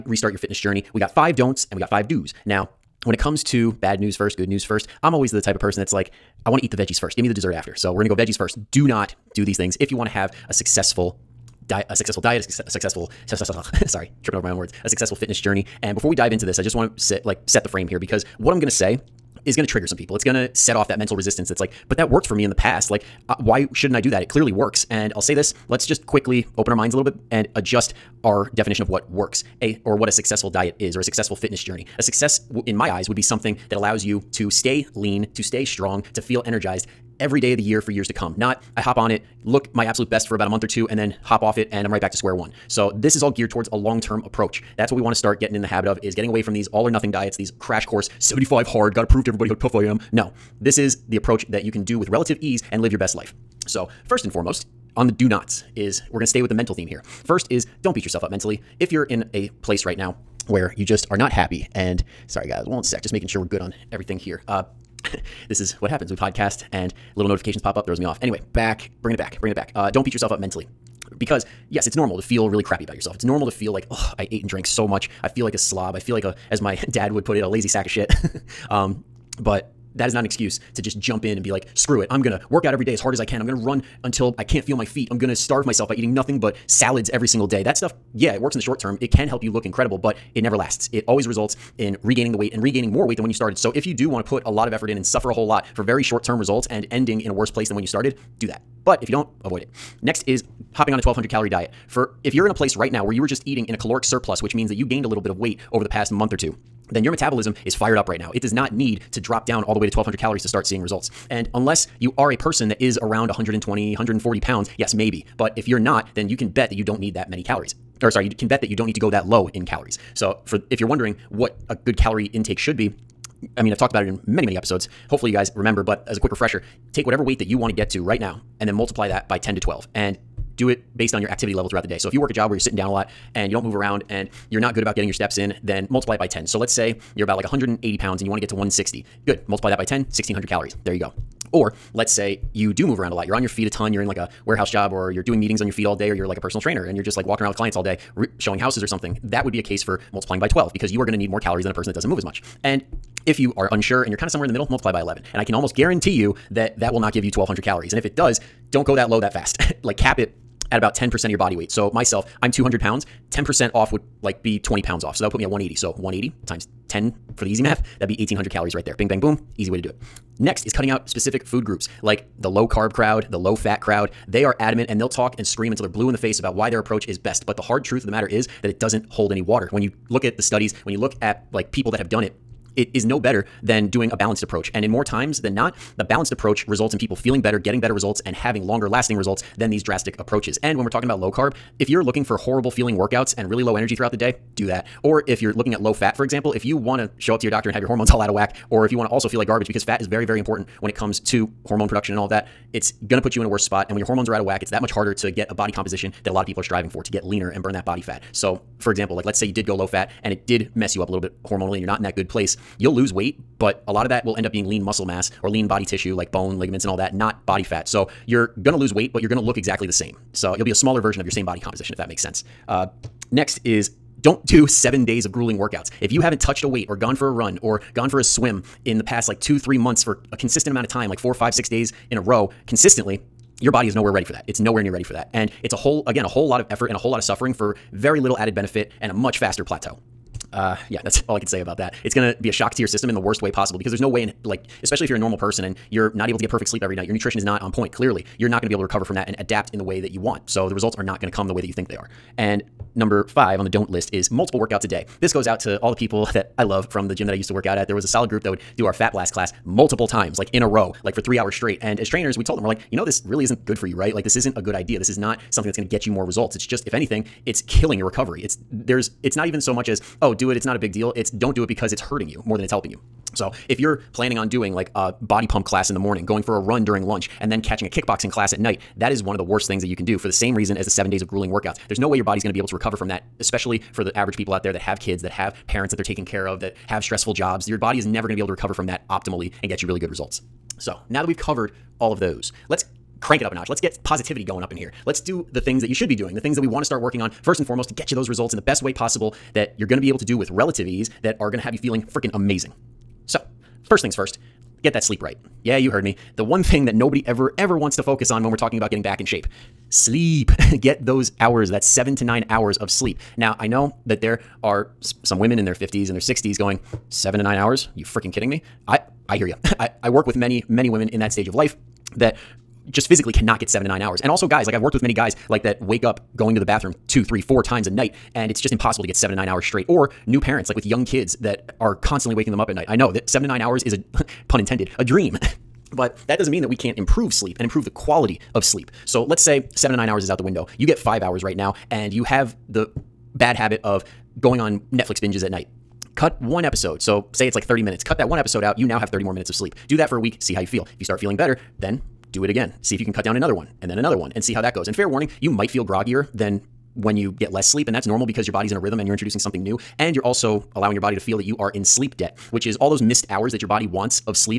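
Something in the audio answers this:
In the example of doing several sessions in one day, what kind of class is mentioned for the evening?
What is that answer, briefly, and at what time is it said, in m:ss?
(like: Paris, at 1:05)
kickboxing, at 4:37.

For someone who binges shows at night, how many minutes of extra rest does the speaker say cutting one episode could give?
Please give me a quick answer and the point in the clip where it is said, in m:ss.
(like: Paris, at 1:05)
30, at 5:47.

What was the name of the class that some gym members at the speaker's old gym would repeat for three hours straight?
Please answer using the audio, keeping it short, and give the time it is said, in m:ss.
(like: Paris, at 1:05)
Fat Blast, at 4:18.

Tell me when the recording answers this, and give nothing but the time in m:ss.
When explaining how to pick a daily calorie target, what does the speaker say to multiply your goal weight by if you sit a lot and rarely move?
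2:15.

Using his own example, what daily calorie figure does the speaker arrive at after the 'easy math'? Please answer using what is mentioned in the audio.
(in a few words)
1800.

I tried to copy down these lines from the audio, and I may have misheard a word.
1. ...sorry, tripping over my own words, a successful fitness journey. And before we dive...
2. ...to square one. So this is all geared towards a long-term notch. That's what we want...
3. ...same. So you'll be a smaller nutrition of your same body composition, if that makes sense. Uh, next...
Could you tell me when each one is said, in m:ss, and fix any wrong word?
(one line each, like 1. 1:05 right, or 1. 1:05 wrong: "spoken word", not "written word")
1. 0:13 right
2. 0:42 wrong: "approach", not "notch"
3. 3:39 wrong: "version", not "nutrition".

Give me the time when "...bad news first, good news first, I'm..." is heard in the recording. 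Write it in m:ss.
0:03.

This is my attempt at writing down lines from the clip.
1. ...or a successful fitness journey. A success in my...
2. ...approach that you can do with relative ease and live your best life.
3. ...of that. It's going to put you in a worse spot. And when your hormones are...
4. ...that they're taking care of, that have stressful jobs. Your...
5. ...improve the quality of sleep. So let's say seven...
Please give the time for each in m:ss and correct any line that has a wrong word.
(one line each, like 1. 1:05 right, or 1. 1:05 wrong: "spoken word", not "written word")
1. 0:30 right
2. 0:51 right
3. 3:22 right
4. 4:45 right
5. 5:37 right.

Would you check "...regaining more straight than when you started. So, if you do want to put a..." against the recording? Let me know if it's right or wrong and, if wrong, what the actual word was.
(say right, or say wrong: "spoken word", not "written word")
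wrong: "weight", not "straight".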